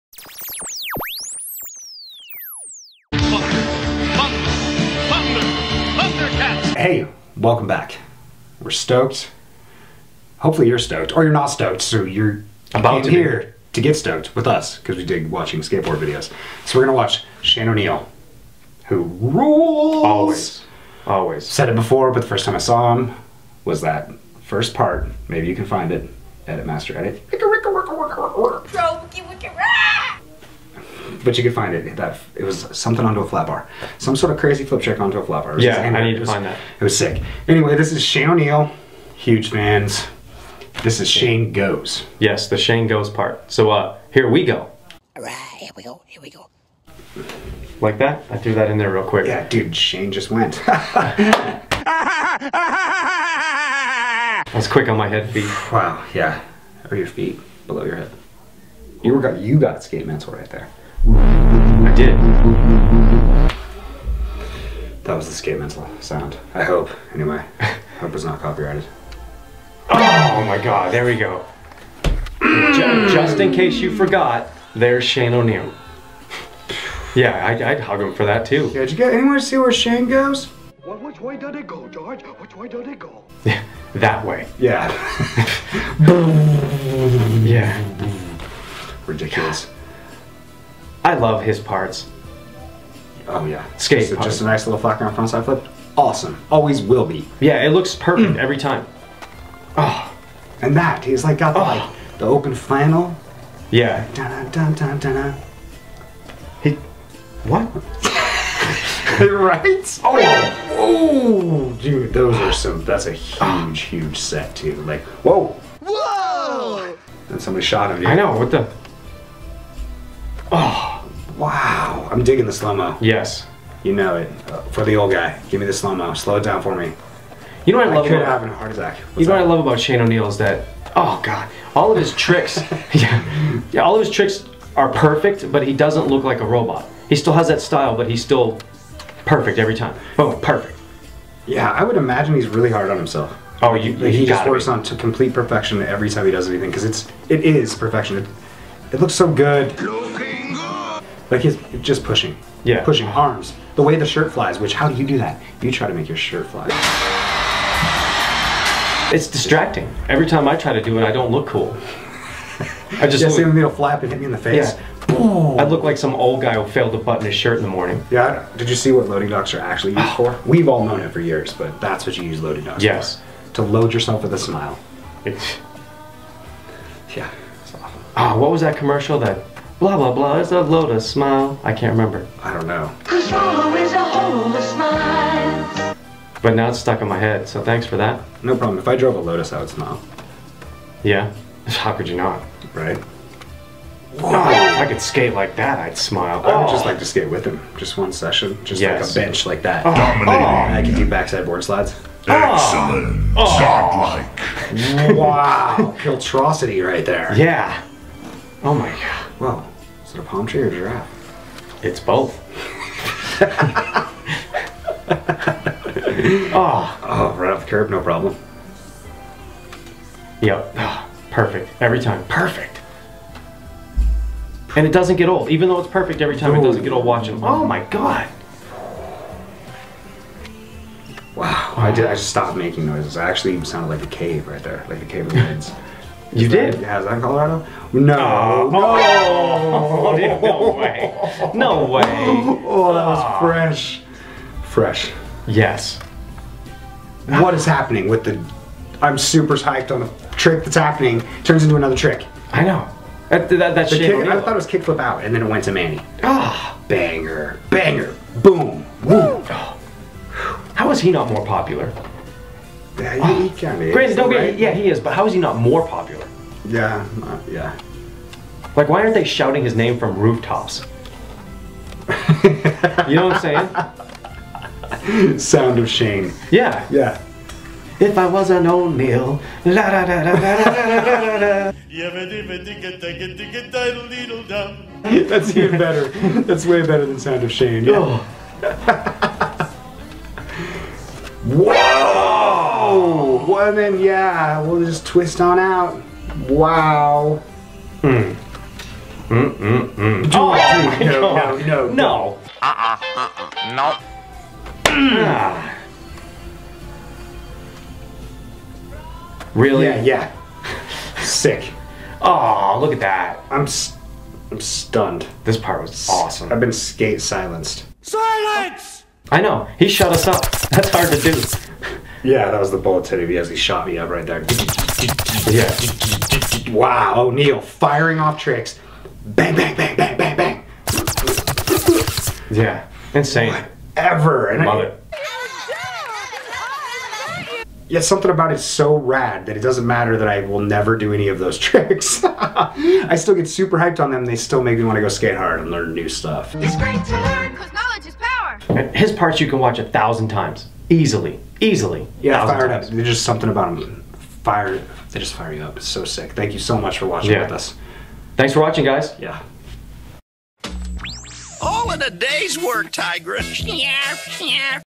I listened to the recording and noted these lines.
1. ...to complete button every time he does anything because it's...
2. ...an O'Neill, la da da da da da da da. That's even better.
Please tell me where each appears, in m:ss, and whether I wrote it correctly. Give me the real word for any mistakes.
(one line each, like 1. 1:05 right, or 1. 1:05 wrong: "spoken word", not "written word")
1. 2:24 wrong: "perfection", not "button"
2. 4:38 right.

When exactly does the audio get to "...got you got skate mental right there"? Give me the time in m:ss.
0:59.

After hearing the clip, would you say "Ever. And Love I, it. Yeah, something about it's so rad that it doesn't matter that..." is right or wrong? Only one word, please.
right.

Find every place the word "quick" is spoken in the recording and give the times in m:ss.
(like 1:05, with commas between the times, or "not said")
0:49, 0:54.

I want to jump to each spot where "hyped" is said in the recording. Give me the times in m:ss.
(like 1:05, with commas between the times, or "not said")
4:09, 5:43.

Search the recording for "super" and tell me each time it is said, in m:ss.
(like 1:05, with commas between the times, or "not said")
4:09, 5:43.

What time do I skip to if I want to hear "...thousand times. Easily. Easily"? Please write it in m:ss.
5:49.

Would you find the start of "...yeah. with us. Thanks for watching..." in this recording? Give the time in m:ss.
5:57.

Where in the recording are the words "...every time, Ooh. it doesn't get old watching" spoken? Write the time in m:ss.
3:46.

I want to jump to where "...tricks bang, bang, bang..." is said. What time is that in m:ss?
5:28.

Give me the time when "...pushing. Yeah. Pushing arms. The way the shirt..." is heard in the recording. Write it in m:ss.
2:32.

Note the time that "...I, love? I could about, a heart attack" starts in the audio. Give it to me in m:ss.
2:07.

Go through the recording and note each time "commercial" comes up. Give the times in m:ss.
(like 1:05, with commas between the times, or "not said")
2:58.